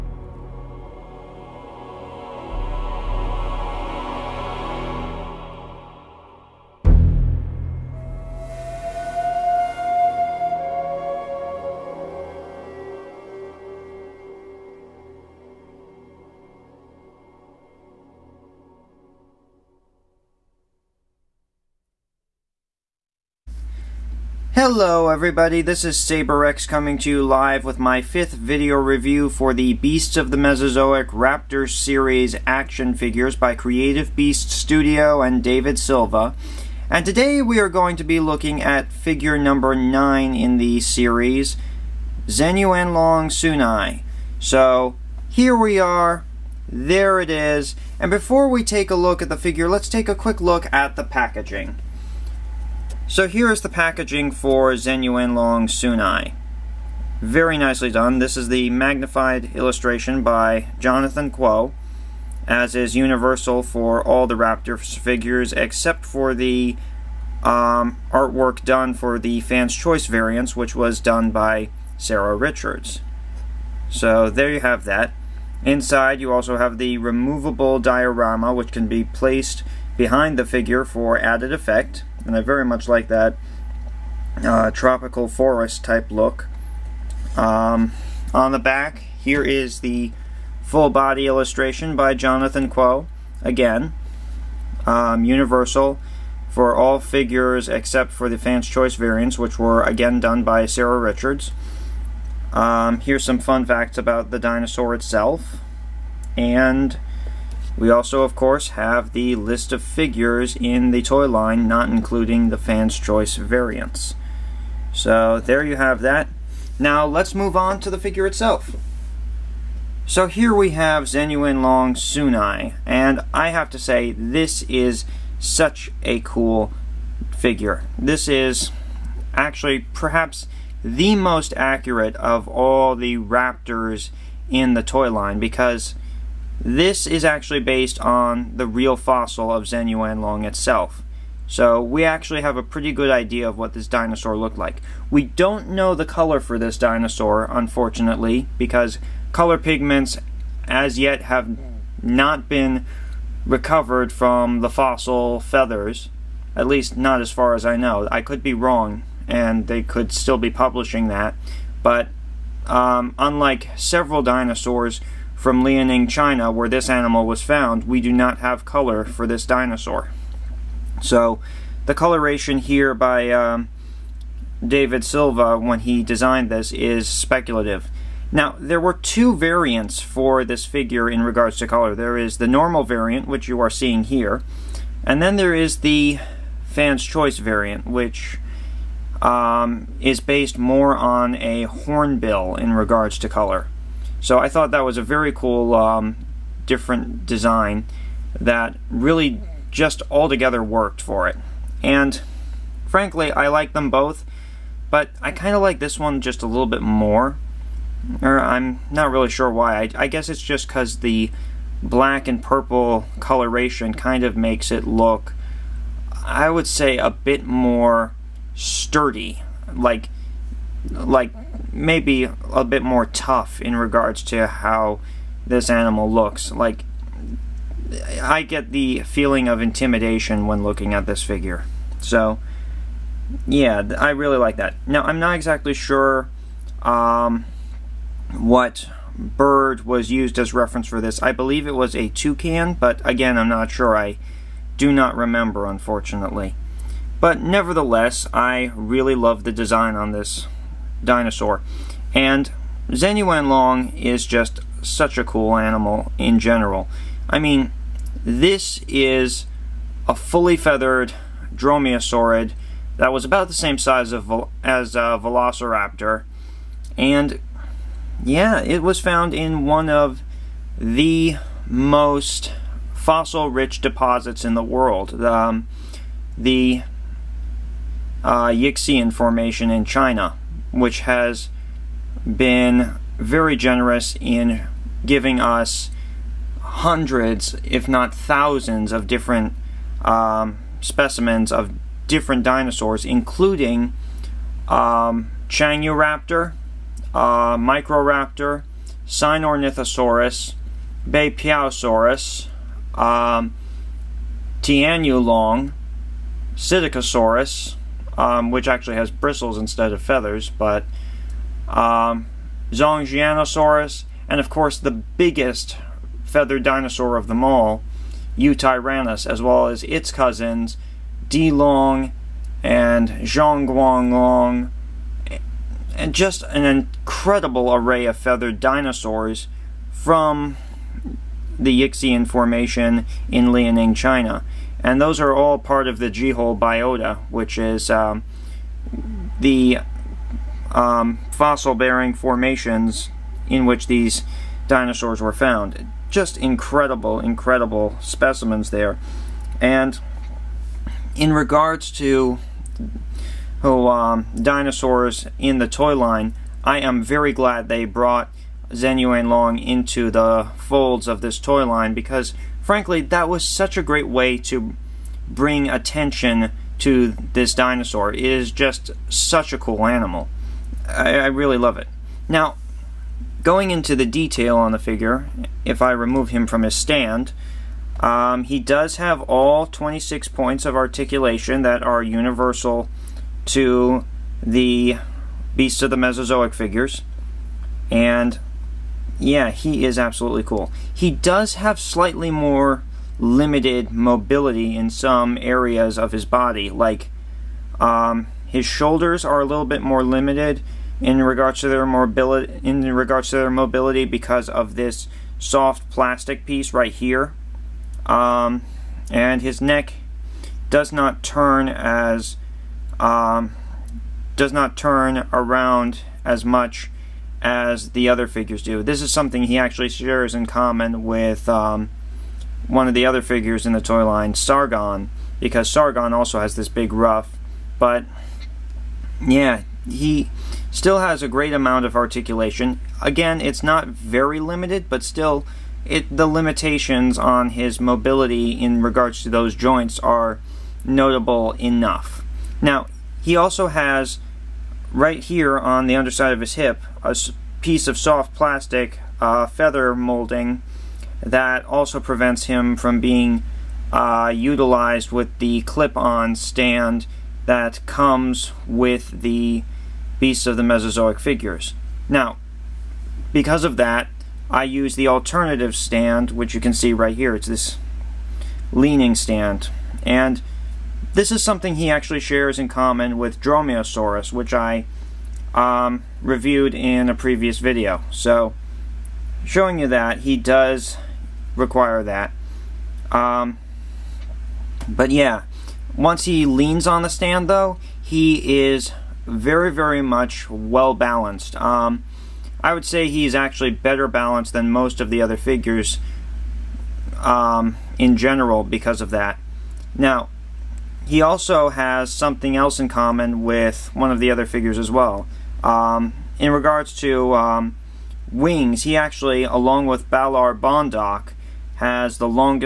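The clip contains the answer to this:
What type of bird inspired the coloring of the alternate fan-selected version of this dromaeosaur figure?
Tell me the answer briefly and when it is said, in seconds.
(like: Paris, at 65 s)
Hornbill, at 191 s.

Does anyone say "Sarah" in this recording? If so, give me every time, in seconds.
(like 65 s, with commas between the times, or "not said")
71 s, 100 s.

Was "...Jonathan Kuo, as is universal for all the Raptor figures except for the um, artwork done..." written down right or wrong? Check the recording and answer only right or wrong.
right.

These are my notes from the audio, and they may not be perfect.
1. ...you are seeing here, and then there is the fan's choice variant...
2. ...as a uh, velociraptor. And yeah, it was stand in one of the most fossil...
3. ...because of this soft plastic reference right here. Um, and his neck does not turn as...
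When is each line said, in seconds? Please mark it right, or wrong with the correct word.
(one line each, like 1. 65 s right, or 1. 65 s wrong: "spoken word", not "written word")
1. 183 s right
2. 264 s wrong: "found", not "stand"
3. 404 s wrong: "piece", not "reference".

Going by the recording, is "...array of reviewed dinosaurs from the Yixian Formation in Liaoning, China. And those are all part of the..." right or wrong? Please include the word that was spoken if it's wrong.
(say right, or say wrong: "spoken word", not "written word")
wrong: "feathered", not "reviewed".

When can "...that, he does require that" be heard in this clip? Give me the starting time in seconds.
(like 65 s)
479 s.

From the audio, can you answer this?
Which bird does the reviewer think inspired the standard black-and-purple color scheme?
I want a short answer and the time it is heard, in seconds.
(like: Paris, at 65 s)
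Toucan, at 242 s.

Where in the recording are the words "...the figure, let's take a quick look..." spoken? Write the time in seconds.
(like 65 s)
49 s.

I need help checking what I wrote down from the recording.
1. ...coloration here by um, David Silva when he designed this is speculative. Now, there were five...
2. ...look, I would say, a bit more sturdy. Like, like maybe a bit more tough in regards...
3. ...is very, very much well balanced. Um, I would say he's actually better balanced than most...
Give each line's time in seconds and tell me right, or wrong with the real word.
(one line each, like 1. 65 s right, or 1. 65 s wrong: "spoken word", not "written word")
1. 171 s wrong: "two", not "five"
2. 214 s right
3. 488 s right.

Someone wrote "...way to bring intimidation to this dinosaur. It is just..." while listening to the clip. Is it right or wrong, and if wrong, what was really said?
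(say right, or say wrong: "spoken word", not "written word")
wrong: "attention", not "intimidation".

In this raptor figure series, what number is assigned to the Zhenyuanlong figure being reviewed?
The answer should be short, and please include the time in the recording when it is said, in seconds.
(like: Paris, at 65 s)
9, at 38 s.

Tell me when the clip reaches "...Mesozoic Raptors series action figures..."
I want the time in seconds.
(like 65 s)
30 s.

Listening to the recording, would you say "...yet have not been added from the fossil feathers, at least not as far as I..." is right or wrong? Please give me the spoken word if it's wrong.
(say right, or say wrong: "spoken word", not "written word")
wrong: "recovered", not "added".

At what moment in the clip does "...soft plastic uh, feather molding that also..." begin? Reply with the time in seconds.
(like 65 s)
447 s.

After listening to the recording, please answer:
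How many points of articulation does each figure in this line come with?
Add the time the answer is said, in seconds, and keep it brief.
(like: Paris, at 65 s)
26, at 379 s.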